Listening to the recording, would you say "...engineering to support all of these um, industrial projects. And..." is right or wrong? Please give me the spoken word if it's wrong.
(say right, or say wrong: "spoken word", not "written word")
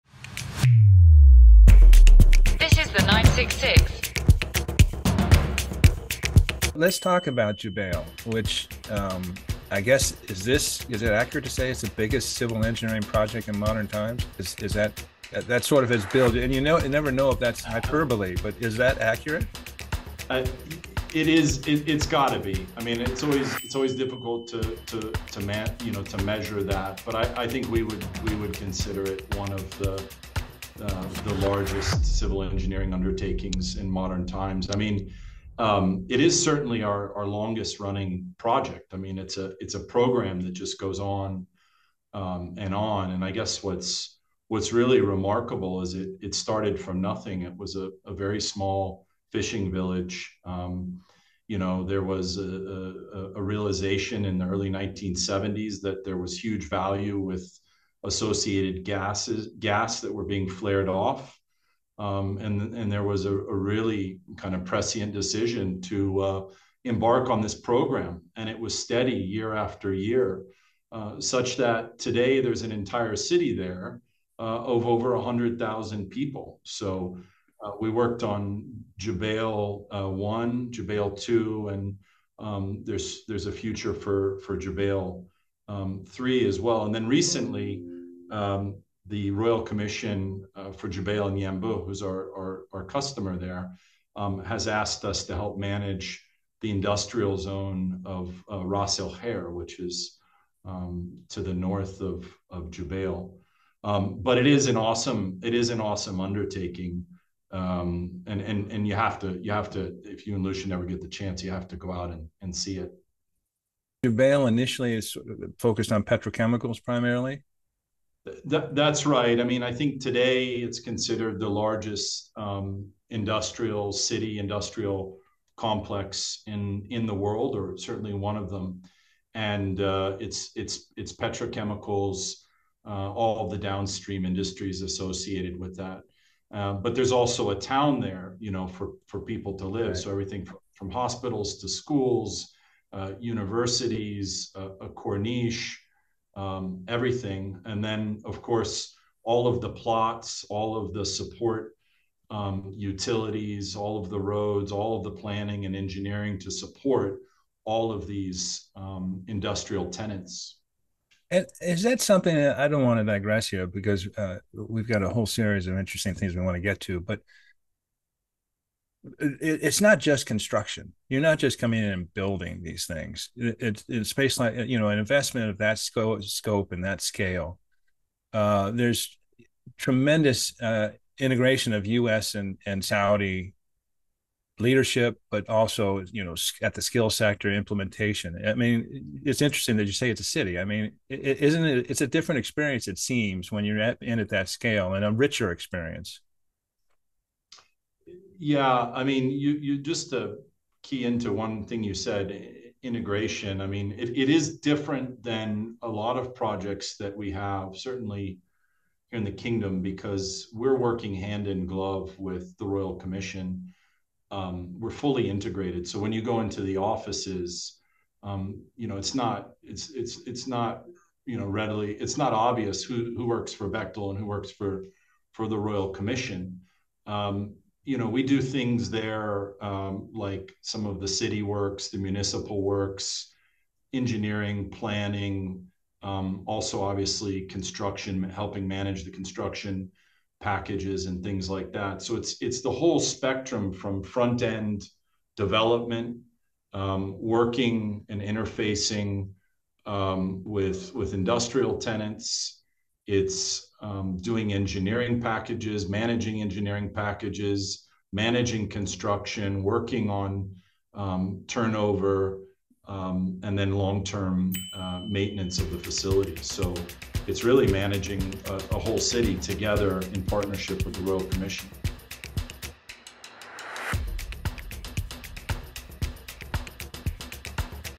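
wrong: "tenants", not "projects".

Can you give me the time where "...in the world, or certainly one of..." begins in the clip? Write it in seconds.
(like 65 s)
126 s.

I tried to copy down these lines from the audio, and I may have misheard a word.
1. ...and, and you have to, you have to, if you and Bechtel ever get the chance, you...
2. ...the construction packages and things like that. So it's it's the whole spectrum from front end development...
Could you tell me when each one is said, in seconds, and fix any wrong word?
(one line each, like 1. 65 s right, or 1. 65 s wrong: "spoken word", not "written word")
1. 108 s wrong: "Lucian", not "Bechtel"
2. 239 s right.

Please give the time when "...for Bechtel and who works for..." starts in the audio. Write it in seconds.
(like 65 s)
223 s.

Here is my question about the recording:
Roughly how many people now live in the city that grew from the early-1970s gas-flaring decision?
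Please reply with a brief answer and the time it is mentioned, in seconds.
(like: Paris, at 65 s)
over 100,000, at 74 s.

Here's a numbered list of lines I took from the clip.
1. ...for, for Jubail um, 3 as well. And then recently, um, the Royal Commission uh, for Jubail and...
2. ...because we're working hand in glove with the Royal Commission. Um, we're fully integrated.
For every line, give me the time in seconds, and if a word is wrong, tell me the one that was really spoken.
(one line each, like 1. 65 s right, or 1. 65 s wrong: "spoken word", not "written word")
1. 83 s right
2. 209 s right.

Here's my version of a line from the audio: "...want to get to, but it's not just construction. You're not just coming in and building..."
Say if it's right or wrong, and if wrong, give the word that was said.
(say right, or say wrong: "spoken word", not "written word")
right.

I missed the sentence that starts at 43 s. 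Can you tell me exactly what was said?
And I guess what's what's really remarkable is it it started from nothing.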